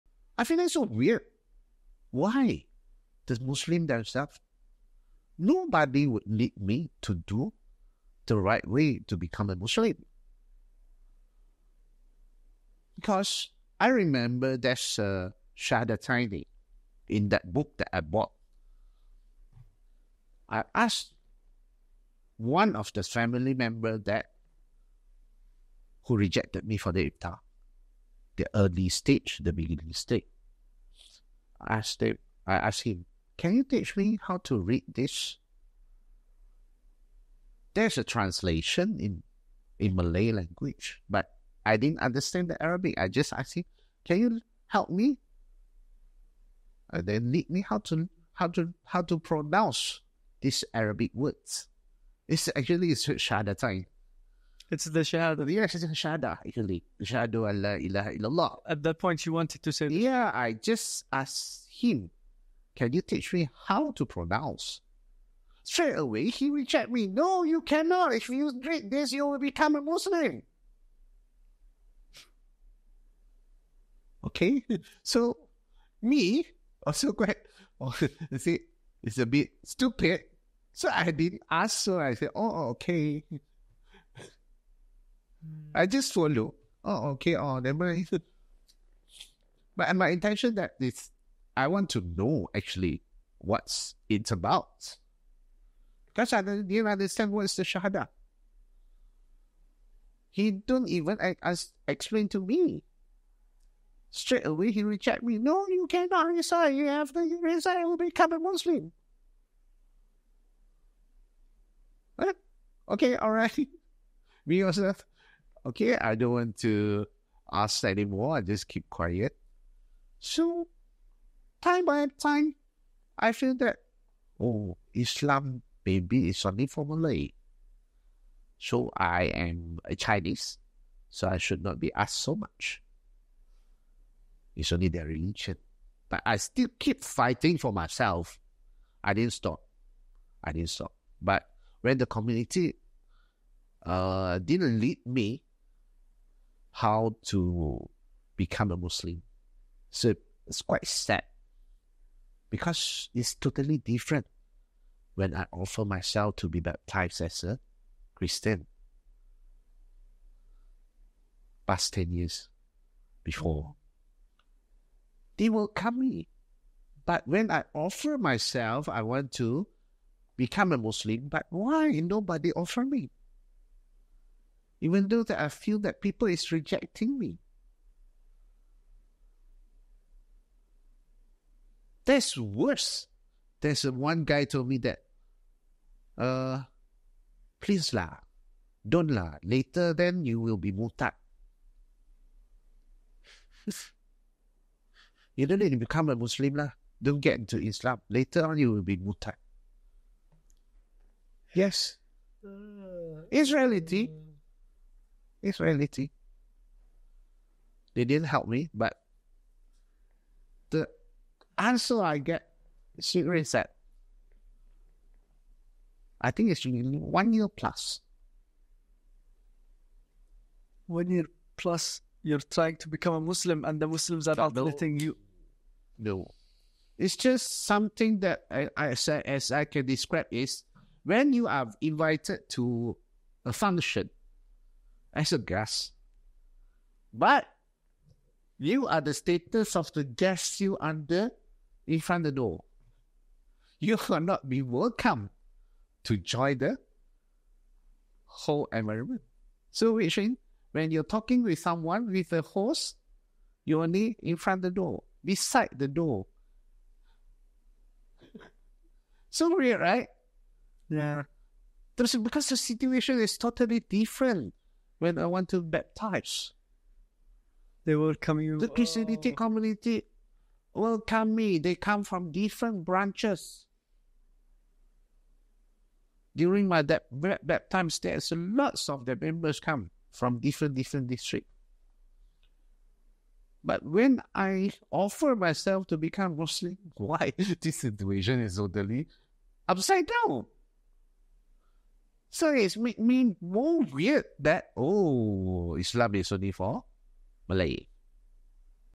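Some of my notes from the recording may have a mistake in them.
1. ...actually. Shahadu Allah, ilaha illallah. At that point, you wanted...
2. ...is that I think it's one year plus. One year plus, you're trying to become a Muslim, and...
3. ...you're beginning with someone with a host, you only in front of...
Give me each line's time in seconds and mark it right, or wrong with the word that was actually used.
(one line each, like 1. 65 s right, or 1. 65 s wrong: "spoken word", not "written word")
1. 56 s right
2. 212 s right
3. 250 s wrong: "talking", not "beginning".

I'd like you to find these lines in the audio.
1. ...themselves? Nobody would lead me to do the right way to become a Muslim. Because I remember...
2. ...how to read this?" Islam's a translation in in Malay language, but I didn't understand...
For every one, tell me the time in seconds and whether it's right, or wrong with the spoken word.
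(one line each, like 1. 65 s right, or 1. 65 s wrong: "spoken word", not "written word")
1. 3 s right
2. 34 s wrong: "There", not "Islam".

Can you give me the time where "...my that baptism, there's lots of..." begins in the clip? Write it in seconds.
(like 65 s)
276 s.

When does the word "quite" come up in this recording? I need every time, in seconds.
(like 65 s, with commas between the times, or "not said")
77 s, 150 s.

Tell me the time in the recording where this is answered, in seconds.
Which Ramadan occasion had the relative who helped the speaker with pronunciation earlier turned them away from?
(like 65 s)
27 s.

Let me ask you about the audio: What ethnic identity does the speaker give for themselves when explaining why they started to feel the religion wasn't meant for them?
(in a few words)
Chinese.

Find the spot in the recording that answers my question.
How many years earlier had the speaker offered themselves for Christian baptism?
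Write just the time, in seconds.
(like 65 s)
161 s.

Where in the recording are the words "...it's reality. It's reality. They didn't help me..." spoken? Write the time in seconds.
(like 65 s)
203 s.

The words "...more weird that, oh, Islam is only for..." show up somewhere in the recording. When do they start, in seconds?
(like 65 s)
293 s.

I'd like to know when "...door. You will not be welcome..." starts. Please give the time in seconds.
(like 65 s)
242 s.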